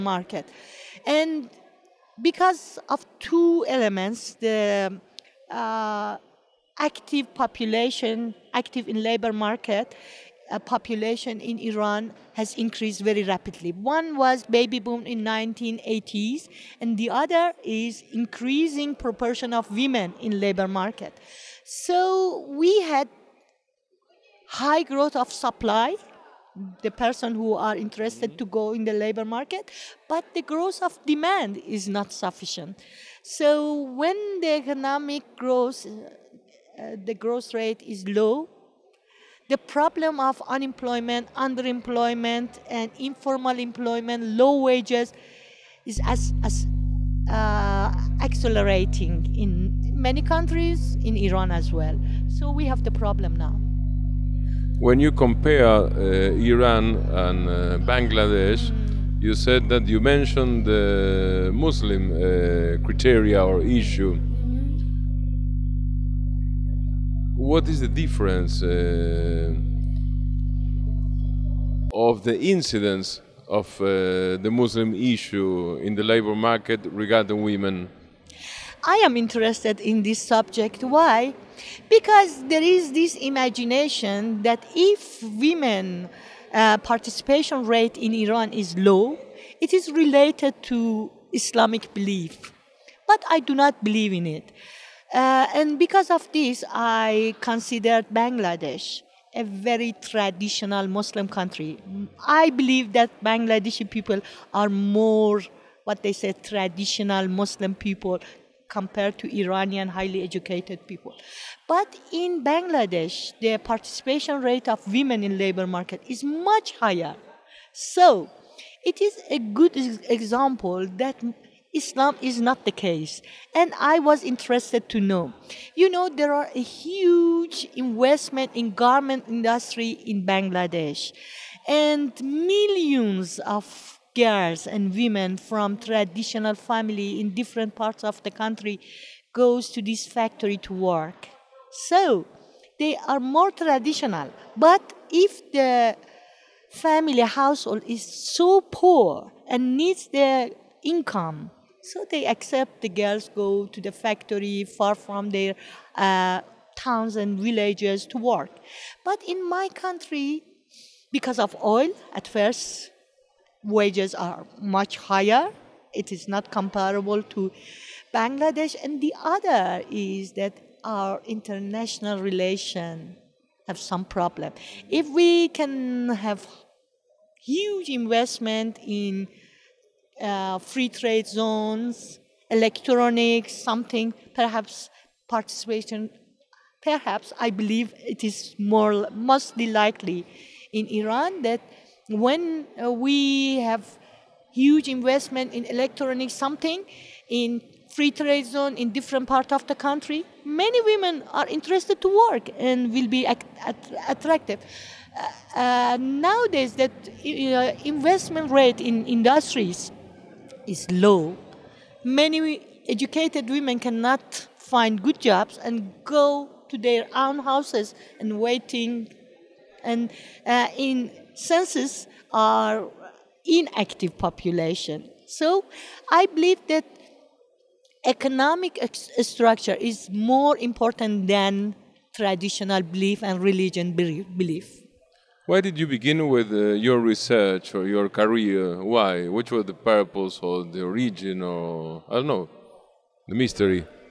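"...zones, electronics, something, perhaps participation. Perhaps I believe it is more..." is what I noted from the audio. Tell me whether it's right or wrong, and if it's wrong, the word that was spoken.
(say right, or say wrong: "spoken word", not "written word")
right.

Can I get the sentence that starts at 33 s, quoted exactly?
So when the economic growth uh, the growth rate is low.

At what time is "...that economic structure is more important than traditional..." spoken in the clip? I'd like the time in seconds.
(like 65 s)
226 s.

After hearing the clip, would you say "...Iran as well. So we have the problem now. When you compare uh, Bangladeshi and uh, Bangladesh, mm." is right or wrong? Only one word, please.
wrong.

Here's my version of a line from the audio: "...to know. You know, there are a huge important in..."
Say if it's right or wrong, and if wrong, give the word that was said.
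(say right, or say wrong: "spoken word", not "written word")
wrong: "investment", not "important".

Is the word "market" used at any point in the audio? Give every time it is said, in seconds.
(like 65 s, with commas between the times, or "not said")
9 s, 20 s, 29 s, 76 s, 115 s.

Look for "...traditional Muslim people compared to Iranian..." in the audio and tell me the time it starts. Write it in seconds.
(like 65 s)
106 s.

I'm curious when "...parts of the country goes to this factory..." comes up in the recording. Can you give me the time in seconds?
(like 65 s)
137 s.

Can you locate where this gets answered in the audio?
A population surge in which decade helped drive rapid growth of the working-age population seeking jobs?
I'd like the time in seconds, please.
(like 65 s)
15 s.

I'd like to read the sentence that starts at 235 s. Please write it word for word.
Why did you begin with uh, your research or your career?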